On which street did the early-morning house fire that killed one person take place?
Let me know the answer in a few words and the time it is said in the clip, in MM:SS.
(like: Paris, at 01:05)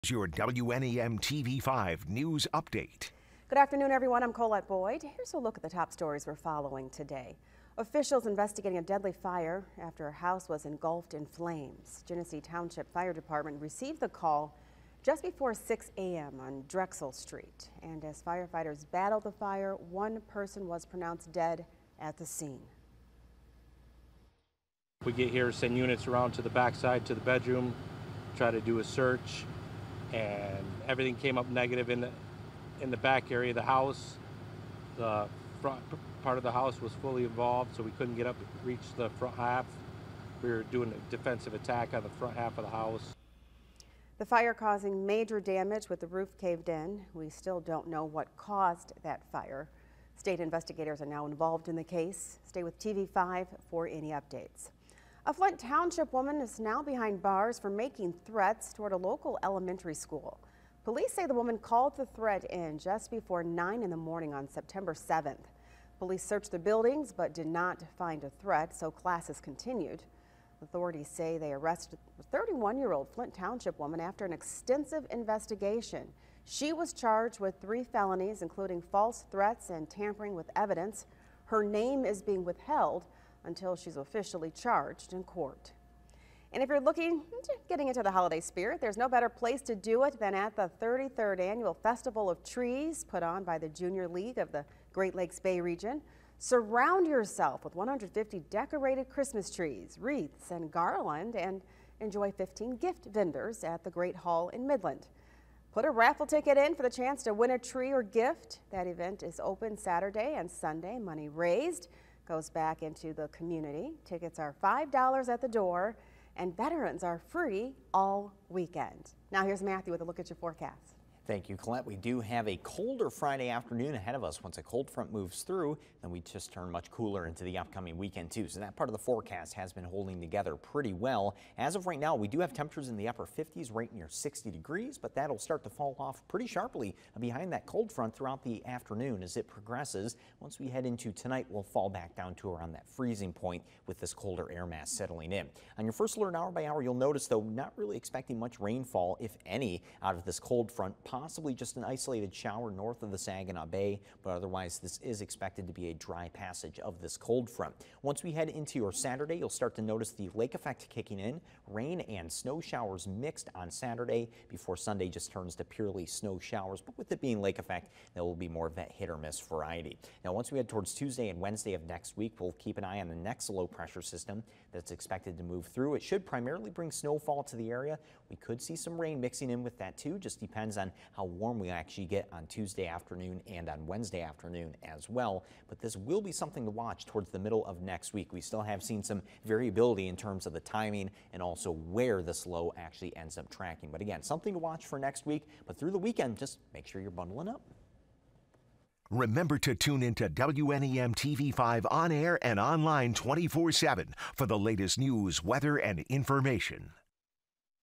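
Drexel Street, at 00:16.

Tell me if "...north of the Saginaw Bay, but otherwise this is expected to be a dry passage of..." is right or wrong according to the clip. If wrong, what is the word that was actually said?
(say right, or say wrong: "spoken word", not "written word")
right.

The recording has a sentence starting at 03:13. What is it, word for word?
But again, something to watch for next week.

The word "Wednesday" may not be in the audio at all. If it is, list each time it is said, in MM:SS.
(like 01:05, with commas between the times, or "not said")
02:51, 03:03.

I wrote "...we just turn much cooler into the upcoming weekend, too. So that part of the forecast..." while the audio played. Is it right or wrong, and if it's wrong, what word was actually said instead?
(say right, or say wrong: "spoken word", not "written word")
right.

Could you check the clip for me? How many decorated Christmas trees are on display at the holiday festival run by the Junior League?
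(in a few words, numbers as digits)
150.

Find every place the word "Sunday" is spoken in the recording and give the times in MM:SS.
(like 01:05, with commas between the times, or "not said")
01:50, 02:44.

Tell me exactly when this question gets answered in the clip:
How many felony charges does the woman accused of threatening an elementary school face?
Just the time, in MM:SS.
01:17.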